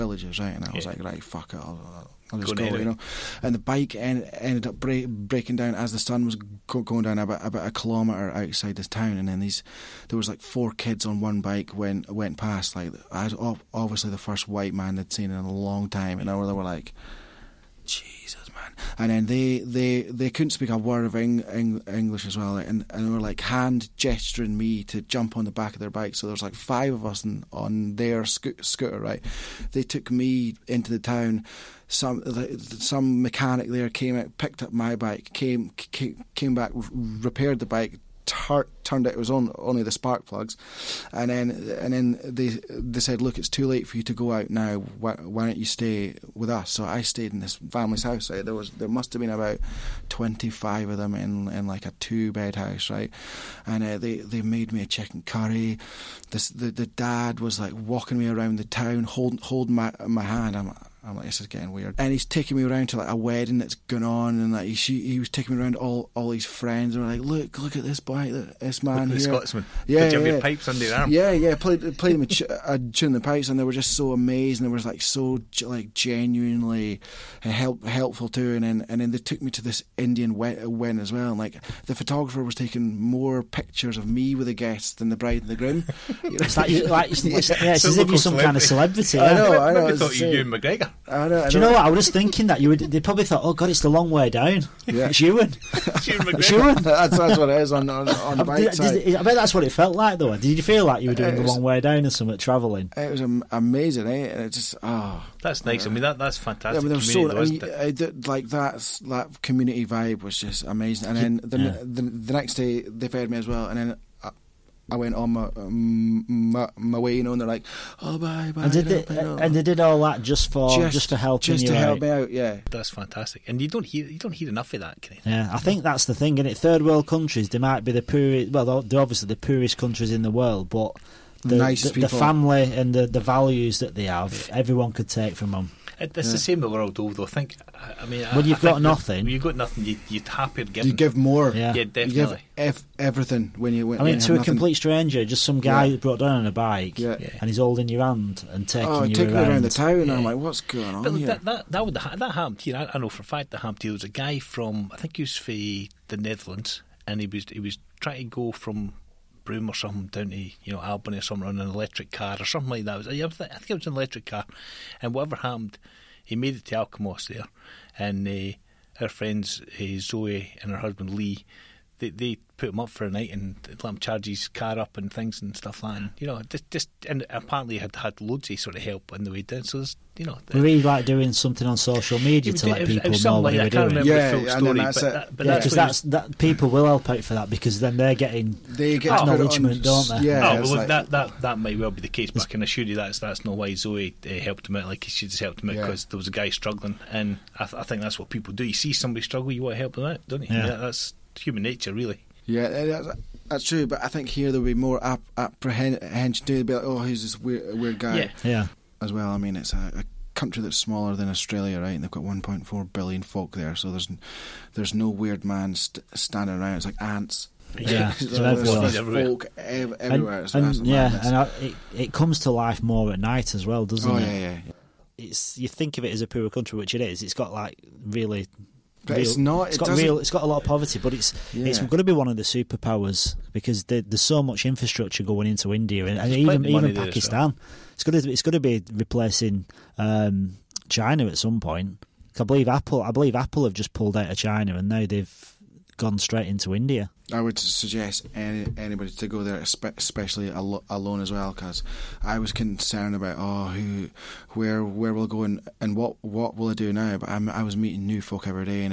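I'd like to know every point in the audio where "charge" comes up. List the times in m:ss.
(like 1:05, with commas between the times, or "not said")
2:53.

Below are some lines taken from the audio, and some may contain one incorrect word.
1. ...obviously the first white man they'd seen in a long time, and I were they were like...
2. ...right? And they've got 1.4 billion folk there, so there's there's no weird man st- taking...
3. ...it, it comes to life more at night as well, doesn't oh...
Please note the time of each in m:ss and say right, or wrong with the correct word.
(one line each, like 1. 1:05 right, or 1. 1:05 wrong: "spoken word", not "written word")
1. 0:13 right
2. 3:31 wrong: "standing", not "taking"
3. 3:41 right.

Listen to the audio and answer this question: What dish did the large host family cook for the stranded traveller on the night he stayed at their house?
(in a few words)
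chicken curry.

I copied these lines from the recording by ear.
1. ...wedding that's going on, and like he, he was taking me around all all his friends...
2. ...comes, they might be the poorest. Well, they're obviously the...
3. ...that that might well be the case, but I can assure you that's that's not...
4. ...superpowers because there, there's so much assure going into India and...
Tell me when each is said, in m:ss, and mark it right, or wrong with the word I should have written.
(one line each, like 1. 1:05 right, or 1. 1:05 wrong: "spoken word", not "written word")
1. 1:03 right
2. 2:07 wrong: "countries", not "comes"
3. 3:11 right
4. 3:52 wrong: "infrastructure", not "assure".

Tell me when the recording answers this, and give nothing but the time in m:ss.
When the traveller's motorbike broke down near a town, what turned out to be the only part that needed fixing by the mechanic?
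0:39.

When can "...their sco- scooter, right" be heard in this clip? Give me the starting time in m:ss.
0:27.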